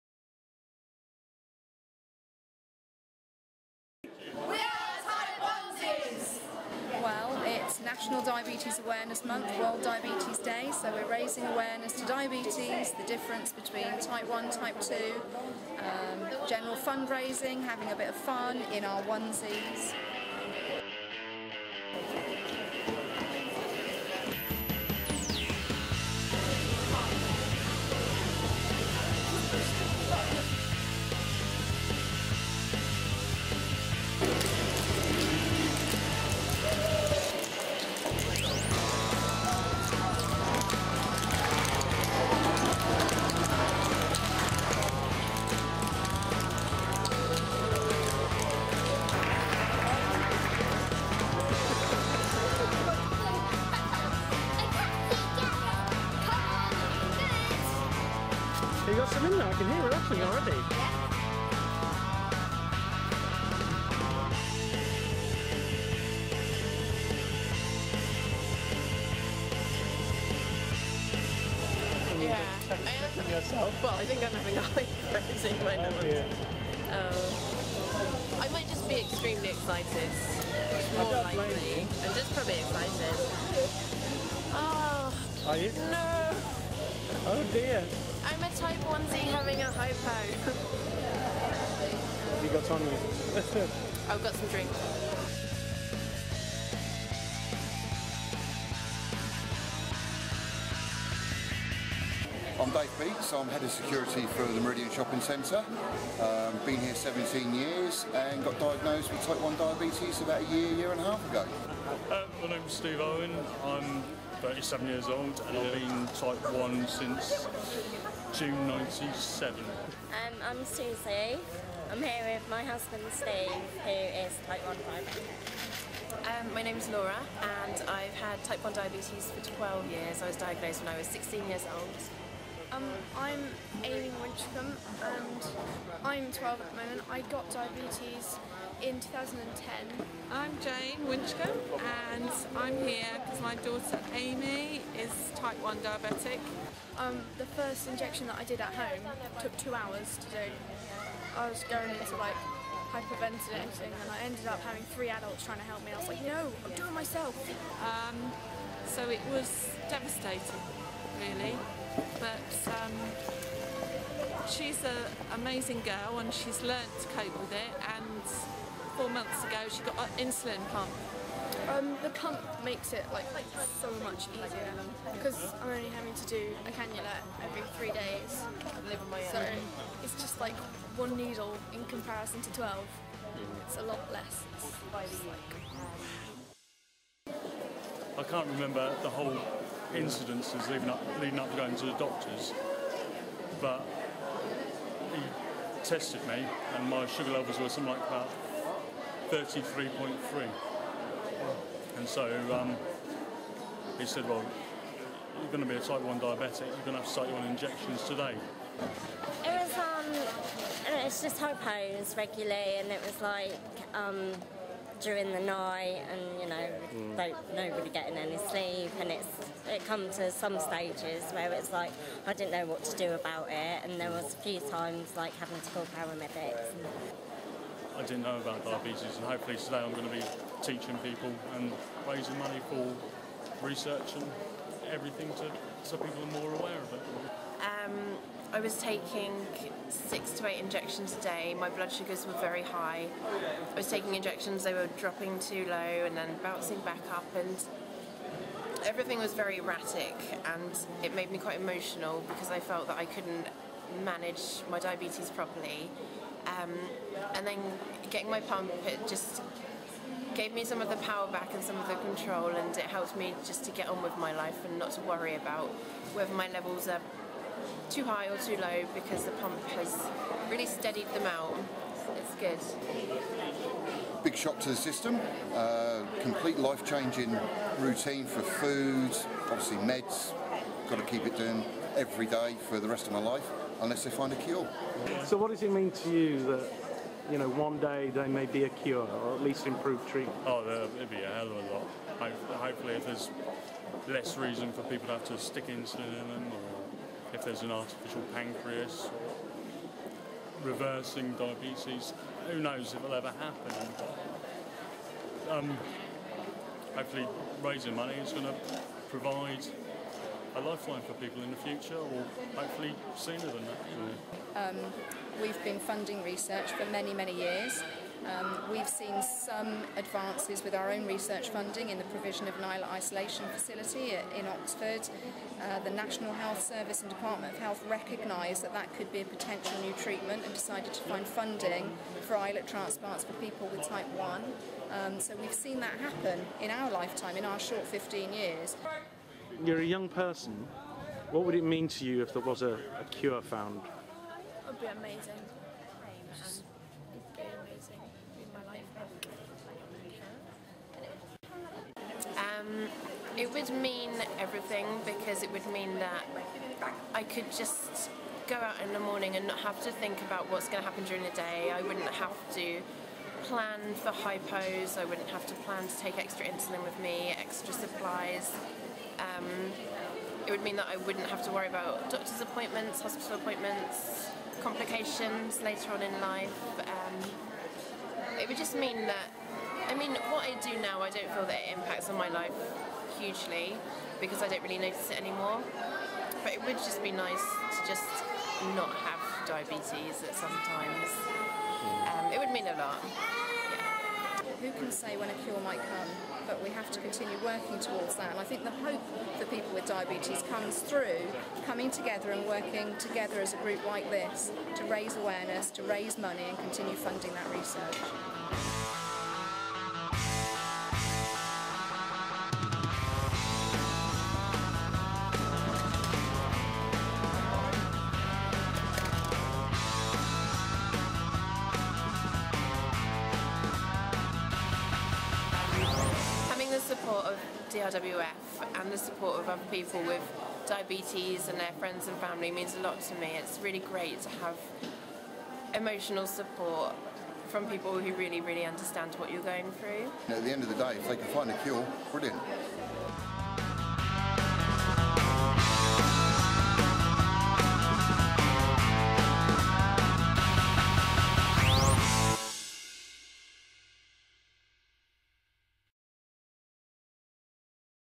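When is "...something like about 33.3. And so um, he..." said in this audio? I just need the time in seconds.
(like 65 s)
197 s.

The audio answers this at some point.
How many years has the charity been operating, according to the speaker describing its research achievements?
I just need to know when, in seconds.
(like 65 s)
337 s.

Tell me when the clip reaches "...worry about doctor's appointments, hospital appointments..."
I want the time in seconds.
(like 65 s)
371 s.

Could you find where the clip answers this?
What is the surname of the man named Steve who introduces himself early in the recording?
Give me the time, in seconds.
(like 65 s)
113 s.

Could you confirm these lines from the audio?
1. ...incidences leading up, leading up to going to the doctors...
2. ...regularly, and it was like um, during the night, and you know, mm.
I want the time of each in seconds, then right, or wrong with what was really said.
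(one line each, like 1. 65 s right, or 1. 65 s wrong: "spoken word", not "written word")
1. 189 s right
2. 212 s right.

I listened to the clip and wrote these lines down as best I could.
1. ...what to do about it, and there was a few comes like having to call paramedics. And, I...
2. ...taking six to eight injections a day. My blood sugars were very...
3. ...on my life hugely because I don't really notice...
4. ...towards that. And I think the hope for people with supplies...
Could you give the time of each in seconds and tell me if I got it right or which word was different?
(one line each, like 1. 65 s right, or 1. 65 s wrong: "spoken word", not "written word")
1. 222 s wrong: "times", not "comes"
2. 238 s right
3. 382 s right
4. 397 s wrong: "diabetes", not "supplies".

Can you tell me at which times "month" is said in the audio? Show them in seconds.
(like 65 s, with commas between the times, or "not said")
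9 s, 169 s.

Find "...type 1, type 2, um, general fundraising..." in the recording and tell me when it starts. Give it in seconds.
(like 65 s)
14 s.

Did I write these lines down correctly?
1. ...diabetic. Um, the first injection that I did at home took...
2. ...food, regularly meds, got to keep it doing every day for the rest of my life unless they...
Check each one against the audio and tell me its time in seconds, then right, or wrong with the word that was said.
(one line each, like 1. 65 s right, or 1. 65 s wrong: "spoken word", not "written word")
1. 145 s right
2. 278 s wrong: "obviously", not "regularly".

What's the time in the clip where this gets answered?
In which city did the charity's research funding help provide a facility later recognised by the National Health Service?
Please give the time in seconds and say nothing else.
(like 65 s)
324 s.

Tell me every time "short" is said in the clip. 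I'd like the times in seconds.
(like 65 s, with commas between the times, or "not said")
337 s.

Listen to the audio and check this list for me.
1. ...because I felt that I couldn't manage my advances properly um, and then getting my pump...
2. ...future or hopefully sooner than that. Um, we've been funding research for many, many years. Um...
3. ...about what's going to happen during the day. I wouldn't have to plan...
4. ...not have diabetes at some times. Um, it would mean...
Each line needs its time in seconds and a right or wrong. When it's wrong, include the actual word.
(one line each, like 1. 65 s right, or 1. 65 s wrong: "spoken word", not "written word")
1. 252 s wrong: "diabetes", not "advances"
2. 311 s right
3. 360 s right
4. 388 s right.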